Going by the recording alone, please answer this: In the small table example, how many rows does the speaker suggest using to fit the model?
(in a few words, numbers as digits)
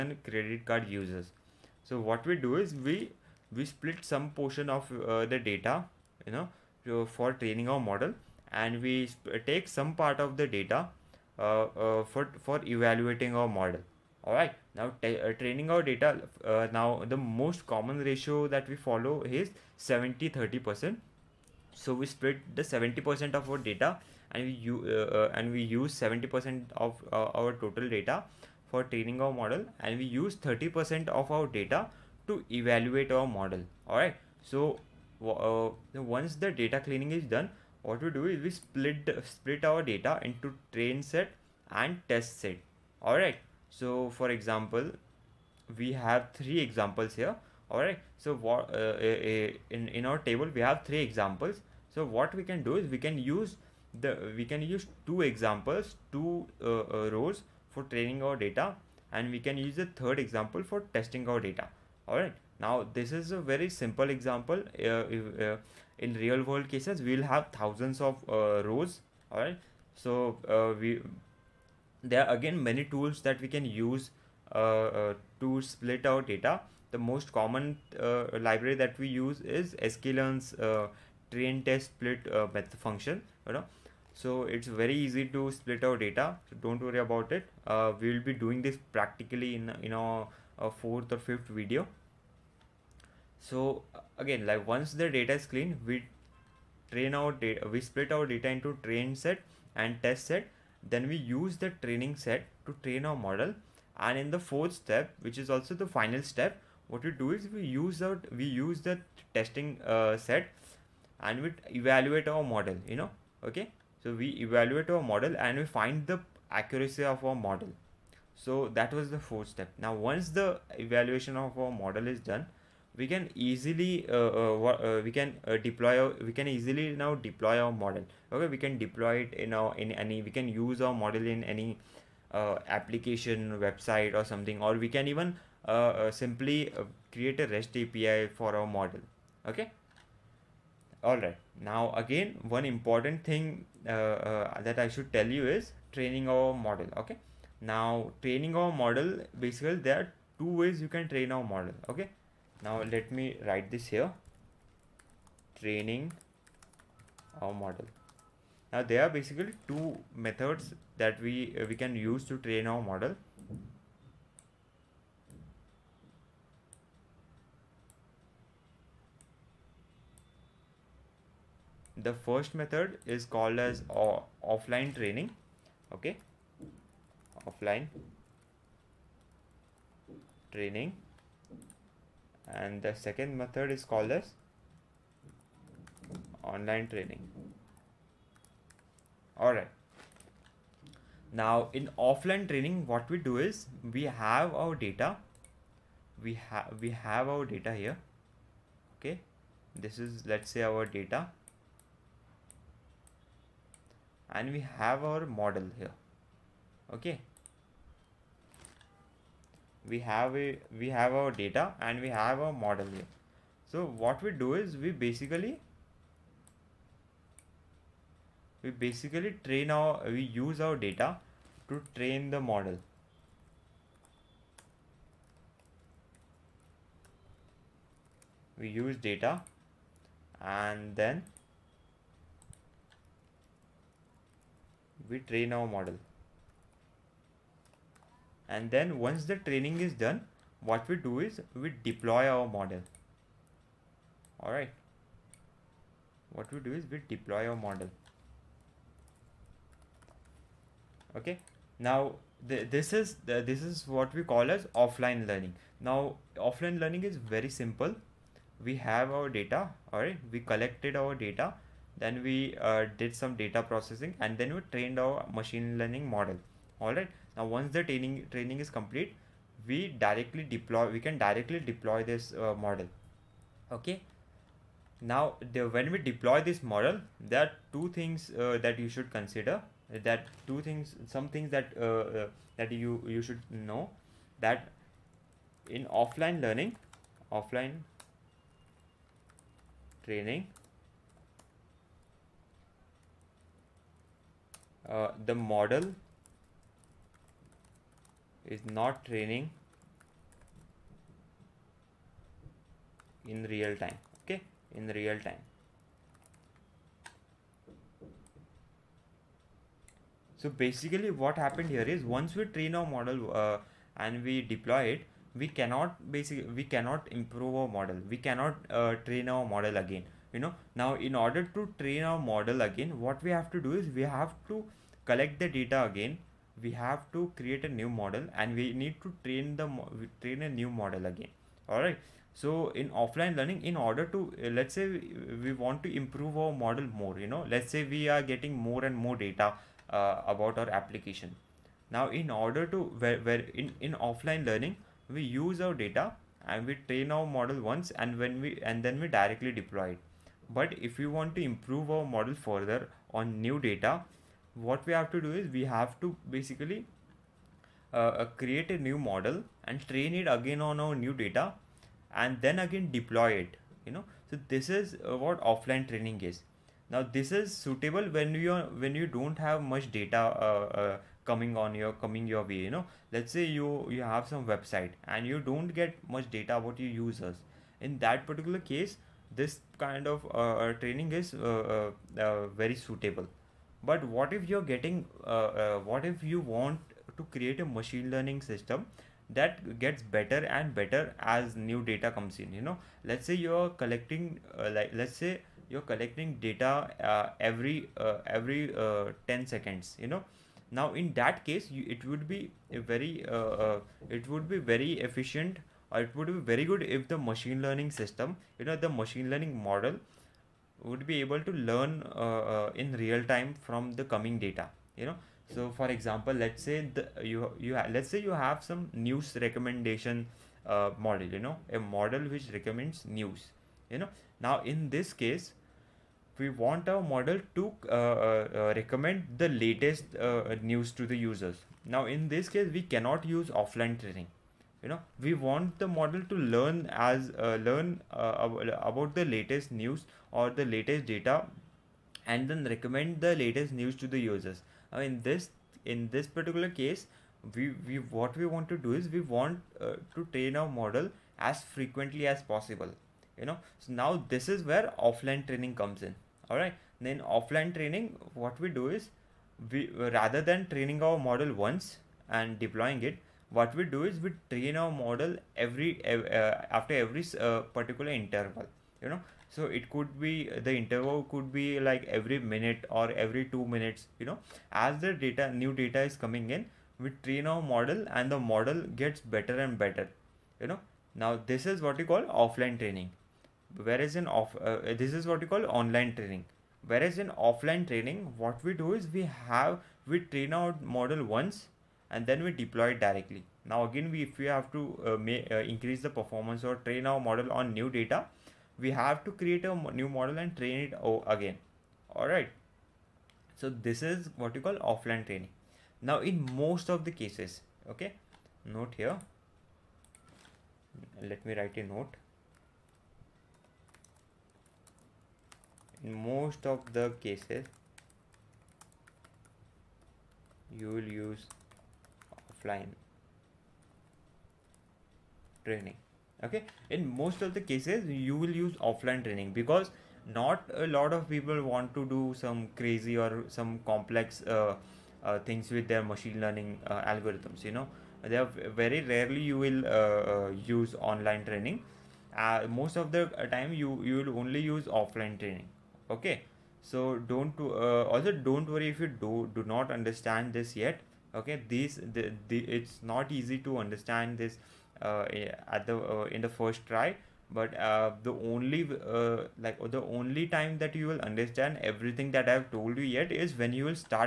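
2.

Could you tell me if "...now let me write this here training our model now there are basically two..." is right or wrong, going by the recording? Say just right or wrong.
right.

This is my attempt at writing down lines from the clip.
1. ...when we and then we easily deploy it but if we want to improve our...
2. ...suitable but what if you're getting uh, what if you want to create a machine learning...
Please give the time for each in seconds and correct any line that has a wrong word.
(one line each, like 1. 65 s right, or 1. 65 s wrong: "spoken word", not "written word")
1. 348 s wrong: "directly", not "easily"
2. 382 s right.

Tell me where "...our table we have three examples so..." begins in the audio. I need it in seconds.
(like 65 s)
50 s.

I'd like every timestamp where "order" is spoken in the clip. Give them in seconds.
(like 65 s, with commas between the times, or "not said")
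321 s, 333 s, 342 s.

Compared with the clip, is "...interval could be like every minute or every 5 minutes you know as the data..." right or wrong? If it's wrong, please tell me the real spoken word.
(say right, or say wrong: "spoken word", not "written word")
wrong: "2", not "5".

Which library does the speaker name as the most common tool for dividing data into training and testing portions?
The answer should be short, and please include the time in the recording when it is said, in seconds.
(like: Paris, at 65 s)
sklearn, at 79 s.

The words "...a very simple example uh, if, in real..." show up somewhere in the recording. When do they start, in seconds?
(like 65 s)
63 s.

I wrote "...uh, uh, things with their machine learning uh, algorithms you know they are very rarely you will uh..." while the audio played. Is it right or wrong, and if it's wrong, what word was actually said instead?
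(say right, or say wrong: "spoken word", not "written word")
right.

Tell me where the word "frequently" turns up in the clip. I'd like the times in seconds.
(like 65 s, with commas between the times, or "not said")
451 s.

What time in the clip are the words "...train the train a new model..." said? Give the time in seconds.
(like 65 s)
329 s.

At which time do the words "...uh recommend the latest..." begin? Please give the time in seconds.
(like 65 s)
428 s.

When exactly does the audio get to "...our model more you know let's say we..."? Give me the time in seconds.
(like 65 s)
336 s.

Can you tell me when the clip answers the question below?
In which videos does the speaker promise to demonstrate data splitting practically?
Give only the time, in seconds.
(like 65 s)
90 s.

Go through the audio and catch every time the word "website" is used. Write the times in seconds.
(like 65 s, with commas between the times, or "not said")
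133 s, 374 s.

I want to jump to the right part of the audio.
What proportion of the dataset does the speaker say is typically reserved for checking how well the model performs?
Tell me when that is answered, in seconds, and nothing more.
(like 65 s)
30 s.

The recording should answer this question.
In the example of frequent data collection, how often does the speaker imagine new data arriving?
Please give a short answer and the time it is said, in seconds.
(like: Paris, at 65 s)
every 10 seconds, at 397 s.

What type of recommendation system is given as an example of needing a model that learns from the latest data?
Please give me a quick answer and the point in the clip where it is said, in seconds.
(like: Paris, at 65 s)
news recommendation, at 418 s.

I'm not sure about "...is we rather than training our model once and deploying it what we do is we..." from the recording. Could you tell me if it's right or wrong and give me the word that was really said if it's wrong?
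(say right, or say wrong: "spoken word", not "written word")
right.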